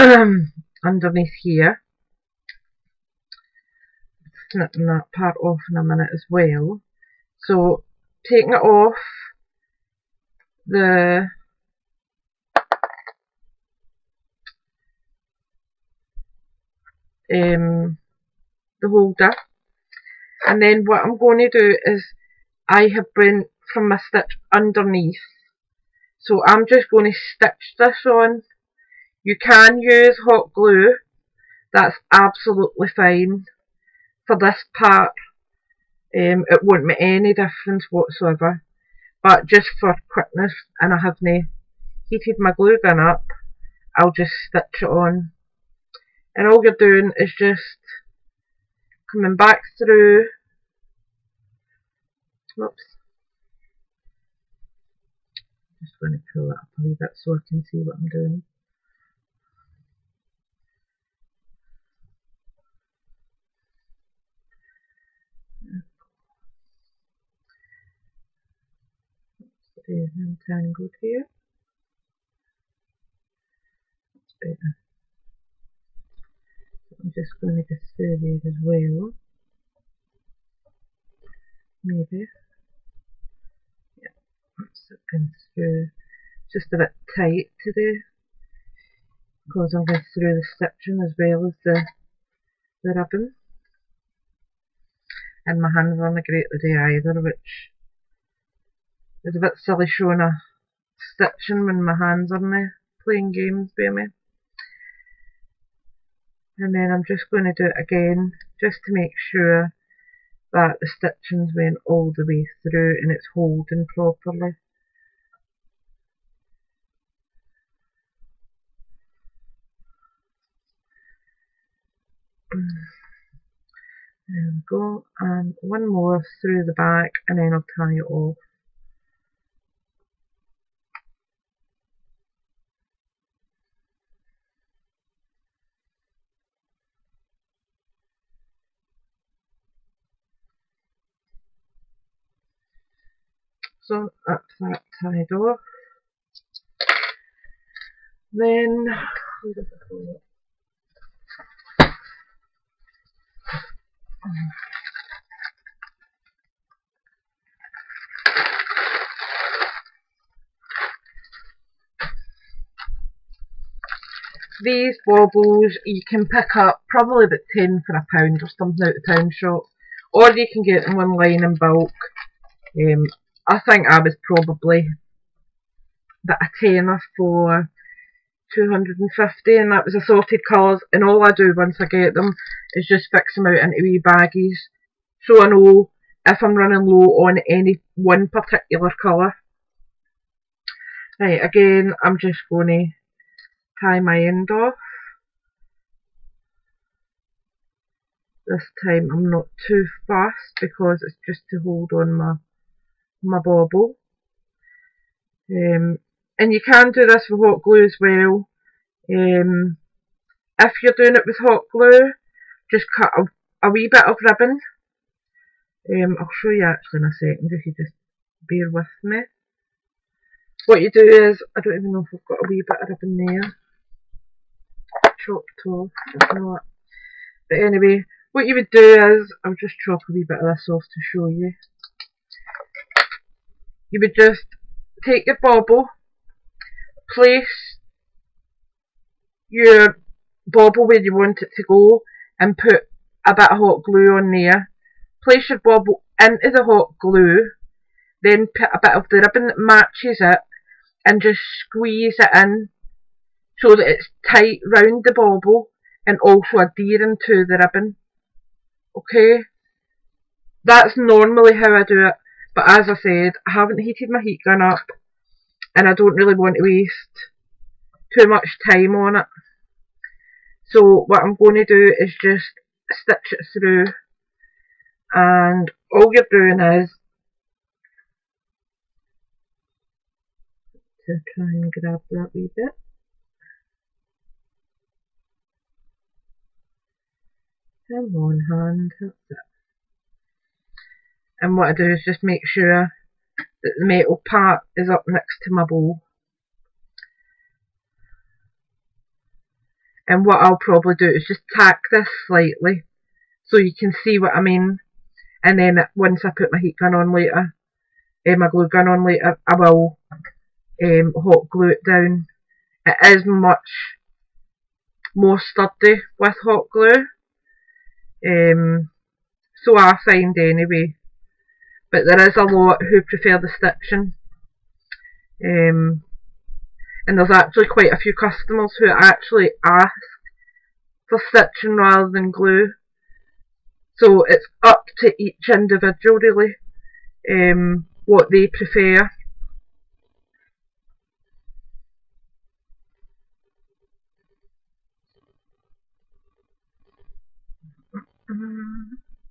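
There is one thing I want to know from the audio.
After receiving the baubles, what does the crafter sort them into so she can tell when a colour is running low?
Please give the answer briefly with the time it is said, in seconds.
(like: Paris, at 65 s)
wee baggies, at 183 s.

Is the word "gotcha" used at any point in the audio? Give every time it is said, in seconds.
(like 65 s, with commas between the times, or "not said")
not said.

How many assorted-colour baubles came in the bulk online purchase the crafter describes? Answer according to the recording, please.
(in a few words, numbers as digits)
250.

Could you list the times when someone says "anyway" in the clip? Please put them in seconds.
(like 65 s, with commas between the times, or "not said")
227 s, 320 s.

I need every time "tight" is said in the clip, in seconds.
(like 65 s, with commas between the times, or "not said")
87 s, 254 s.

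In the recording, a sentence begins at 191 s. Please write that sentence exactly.
Right, again, I'm just going to tie my end off.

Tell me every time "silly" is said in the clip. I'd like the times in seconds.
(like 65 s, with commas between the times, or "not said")
99 s.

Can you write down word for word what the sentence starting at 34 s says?
For this part, um, it won't make any difference whatsoever.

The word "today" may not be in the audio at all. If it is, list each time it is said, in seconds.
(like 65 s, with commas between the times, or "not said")
87 s, 96 s.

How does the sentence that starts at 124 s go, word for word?
There we go, and one more through the back and then I'll tie it off.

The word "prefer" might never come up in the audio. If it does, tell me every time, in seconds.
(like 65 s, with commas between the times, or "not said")
323 s, 338 s.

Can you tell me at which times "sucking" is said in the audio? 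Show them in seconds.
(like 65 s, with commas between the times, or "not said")
84 s.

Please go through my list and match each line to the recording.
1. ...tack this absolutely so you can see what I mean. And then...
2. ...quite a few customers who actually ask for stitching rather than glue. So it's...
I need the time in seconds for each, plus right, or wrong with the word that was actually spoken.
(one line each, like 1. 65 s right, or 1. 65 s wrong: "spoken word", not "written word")
1. 301 s wrong: "slightly", not "absolutely"
2. 327 s right.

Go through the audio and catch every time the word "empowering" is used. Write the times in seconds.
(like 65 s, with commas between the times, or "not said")
not said.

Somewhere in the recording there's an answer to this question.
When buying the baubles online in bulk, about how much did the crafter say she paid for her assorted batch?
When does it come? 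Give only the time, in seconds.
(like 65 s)
176 s.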